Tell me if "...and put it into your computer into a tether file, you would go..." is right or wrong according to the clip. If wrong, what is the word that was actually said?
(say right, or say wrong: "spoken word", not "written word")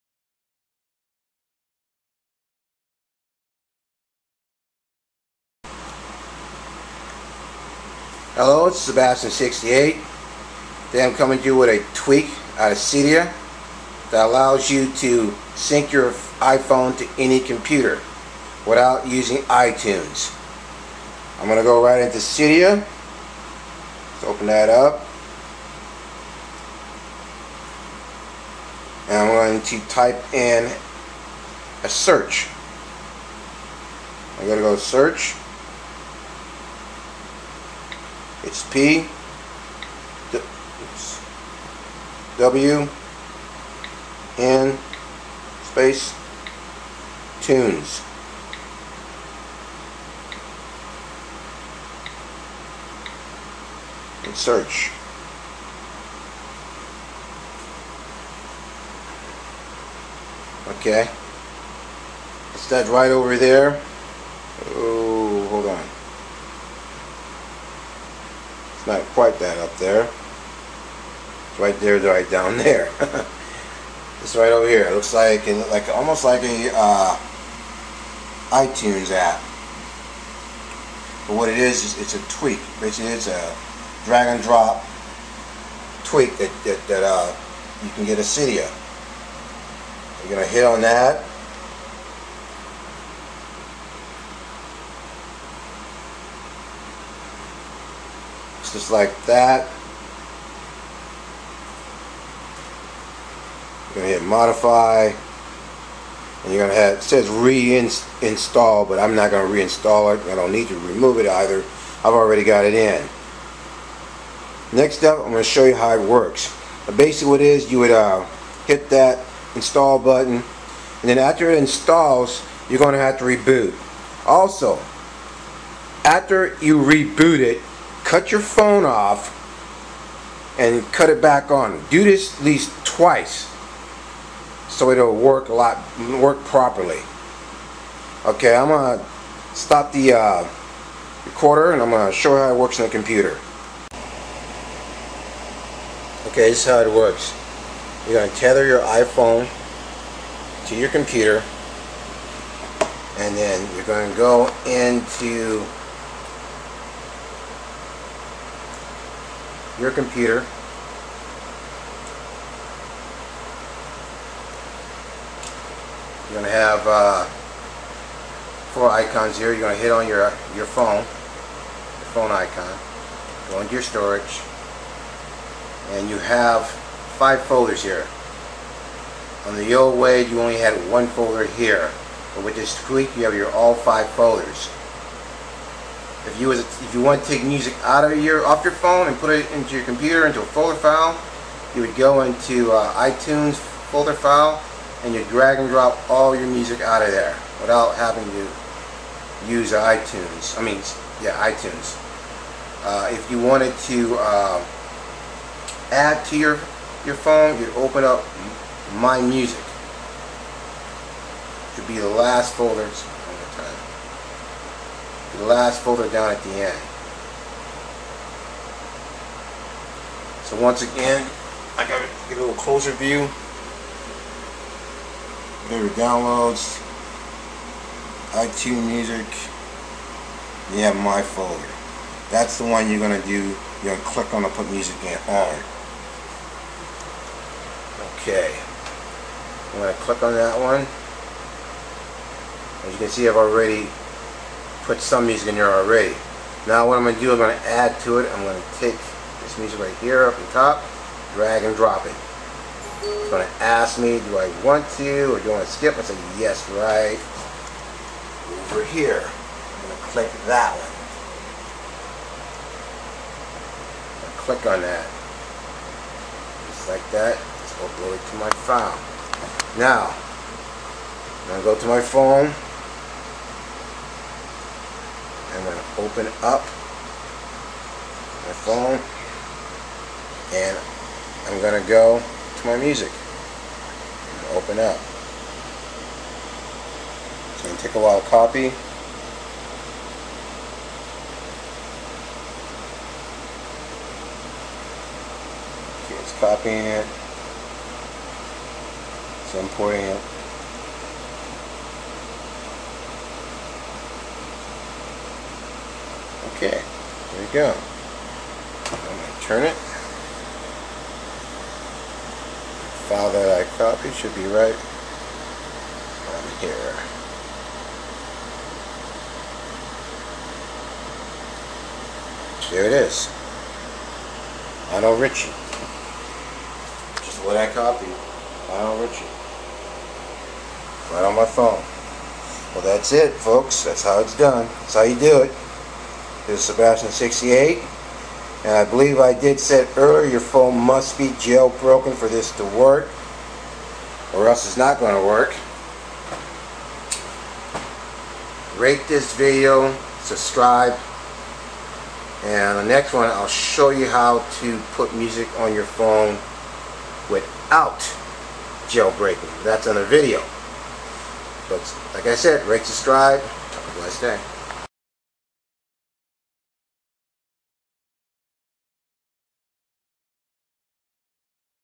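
wrong: "folder", not "tether".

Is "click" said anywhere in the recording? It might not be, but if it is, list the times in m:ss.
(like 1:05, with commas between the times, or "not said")
3:54, 3:59, 4:20, 4:24.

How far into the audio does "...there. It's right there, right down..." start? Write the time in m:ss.
1:09.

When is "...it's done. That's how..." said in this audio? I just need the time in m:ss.
5:34.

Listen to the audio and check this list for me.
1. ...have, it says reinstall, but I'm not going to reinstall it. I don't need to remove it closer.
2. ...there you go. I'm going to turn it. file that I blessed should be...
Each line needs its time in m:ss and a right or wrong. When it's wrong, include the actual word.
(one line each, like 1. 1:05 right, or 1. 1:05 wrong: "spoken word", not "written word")
1. 1:46 wrong: "either", not "closer"
2. 5:06 wrong: "copied", not "blessed".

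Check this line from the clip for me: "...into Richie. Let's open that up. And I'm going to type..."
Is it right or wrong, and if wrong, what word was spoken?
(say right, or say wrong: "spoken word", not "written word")
wrong: "Cydia", not "Richie".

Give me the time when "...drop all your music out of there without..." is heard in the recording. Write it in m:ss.
3:15.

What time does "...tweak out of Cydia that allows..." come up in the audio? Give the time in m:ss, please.
0:11.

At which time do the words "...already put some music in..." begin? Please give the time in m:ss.
4:03.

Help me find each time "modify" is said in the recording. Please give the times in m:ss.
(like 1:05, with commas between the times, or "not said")
1:44.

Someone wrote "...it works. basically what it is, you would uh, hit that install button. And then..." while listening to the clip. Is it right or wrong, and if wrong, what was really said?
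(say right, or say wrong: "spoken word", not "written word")
right.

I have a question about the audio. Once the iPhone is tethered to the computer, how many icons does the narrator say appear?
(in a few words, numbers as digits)
4.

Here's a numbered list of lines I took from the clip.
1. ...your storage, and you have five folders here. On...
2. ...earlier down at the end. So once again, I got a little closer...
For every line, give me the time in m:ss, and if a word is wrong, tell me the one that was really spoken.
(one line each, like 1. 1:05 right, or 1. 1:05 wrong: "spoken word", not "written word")
1. 2:53 right
2. 3:35 wrong: "folder", not "earlier".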